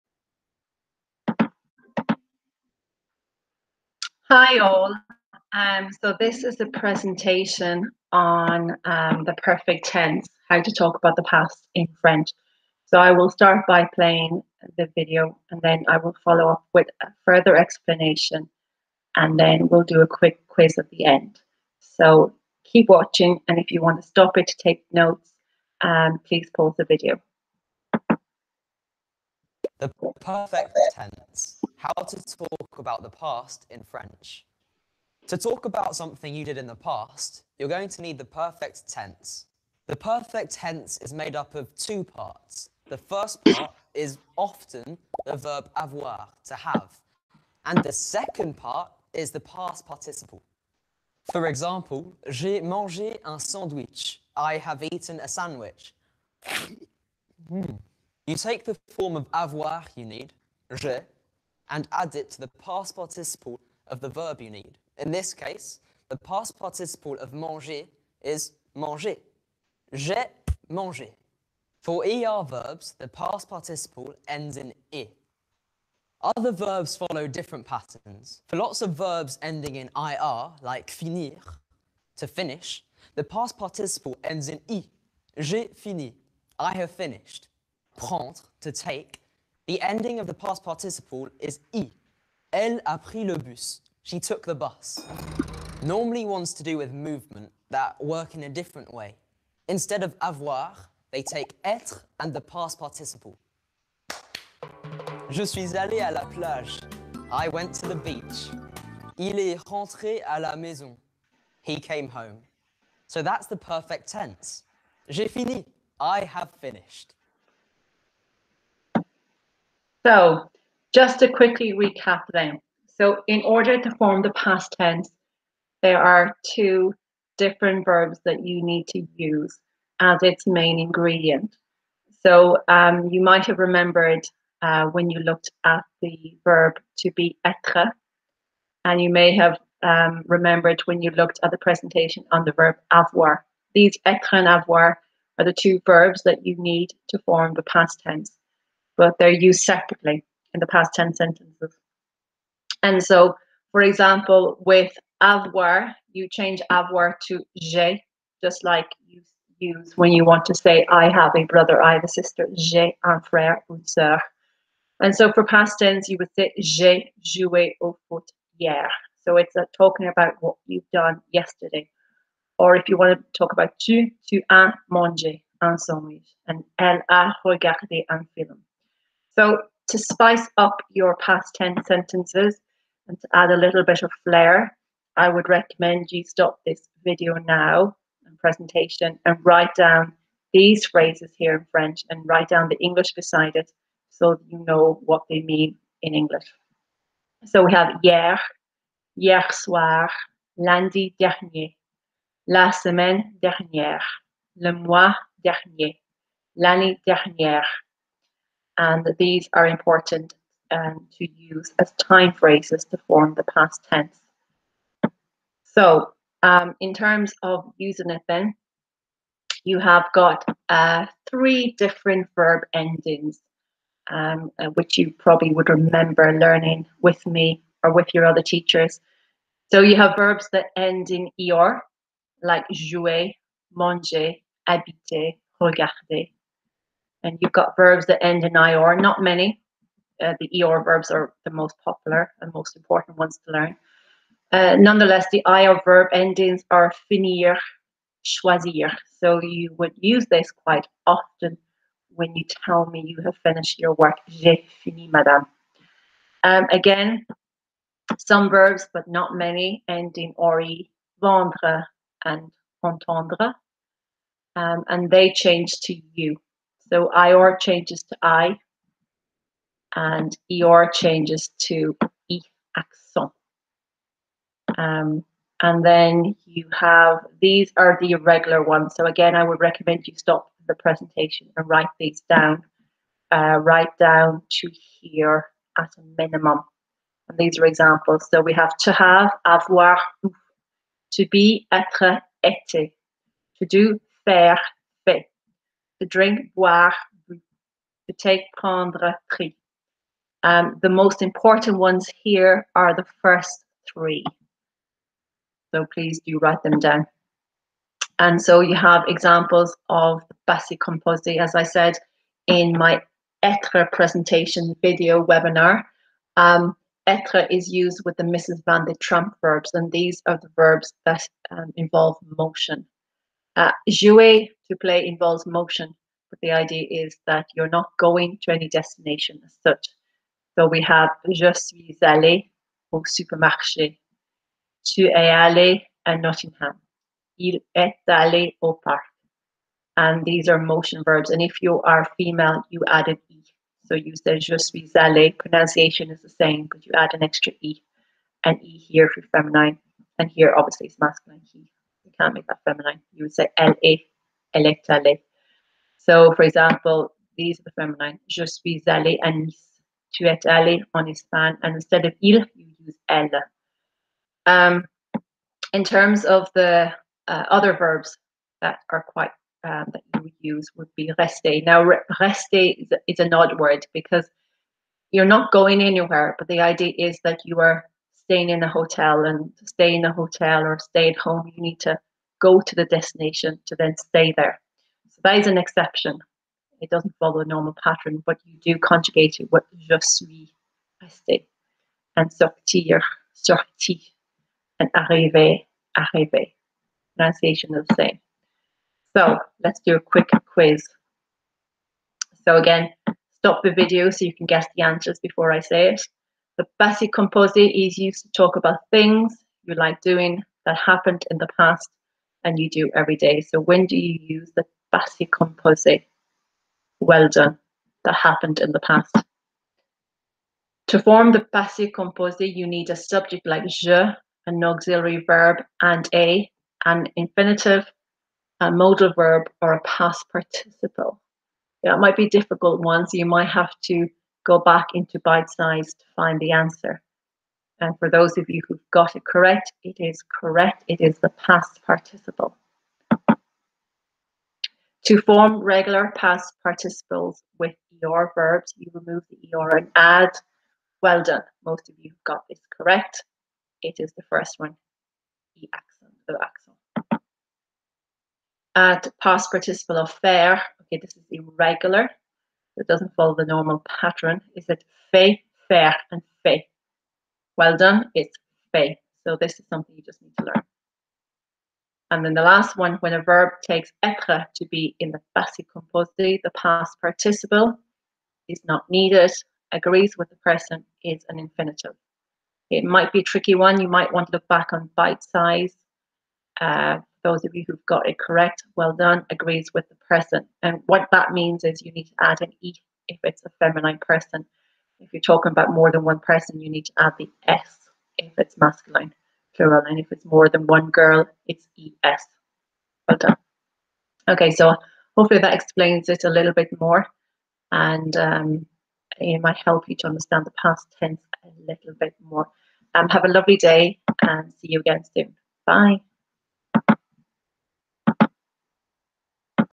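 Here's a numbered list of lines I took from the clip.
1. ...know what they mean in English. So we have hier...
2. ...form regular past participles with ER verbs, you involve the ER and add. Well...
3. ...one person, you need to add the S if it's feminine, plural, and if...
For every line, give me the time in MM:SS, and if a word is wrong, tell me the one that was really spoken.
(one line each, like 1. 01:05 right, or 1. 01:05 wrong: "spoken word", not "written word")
1. 03:14 right
2. 07:25 wrong: "remove", not "involve"
3. 08:16 wrong: "masculine", not "feminine".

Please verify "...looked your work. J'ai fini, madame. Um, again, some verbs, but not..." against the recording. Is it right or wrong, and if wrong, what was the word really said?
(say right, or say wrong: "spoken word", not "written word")
wrong: "finished", not "looked".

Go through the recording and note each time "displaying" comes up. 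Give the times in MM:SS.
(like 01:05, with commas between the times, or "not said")
not said.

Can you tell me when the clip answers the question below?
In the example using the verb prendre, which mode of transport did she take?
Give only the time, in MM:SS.
01:32.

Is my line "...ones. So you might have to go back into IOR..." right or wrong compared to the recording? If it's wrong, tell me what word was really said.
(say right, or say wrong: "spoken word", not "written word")
wrong: "Bitesize", not "IOR".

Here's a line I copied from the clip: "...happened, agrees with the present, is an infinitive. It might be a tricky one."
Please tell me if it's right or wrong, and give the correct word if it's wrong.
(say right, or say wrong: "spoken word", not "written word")
wrong: "needed", not "happened".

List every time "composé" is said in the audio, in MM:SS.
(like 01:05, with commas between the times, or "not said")
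05:10, 06:47, 06:55, 07:01, 07:55.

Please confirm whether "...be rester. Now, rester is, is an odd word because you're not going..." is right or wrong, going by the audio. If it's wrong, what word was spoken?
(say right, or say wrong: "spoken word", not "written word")
right.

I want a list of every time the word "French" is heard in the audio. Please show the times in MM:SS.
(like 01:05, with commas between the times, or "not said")
00:11, 00:33, 03:11.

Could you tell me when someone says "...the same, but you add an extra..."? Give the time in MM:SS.
05:46.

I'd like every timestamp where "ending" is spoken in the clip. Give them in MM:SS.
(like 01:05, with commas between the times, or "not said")
01:19, 01:29, 03:42, 04:06.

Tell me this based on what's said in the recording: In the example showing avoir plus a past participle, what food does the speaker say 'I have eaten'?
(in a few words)
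a sandwich.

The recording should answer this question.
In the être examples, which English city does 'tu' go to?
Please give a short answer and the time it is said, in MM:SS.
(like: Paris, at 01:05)
Nottingham, at 05:36.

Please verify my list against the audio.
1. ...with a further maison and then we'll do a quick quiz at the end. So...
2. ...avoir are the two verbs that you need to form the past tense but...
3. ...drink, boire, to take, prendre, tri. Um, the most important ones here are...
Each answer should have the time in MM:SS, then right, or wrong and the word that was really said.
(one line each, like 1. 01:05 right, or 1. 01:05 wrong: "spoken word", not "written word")
1. 00:16 wrong: "explanation", not "maison"
2. 02:24 right
3. 04:56 right.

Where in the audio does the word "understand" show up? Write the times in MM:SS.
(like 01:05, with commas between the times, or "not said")
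08:30.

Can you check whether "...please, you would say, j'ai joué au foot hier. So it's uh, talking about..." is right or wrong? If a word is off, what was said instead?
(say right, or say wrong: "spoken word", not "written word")
wrong: "tense", not "please".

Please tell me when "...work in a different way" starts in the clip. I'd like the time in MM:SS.
01:38.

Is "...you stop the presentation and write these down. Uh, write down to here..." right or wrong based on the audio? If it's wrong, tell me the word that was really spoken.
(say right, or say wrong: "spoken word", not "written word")
right.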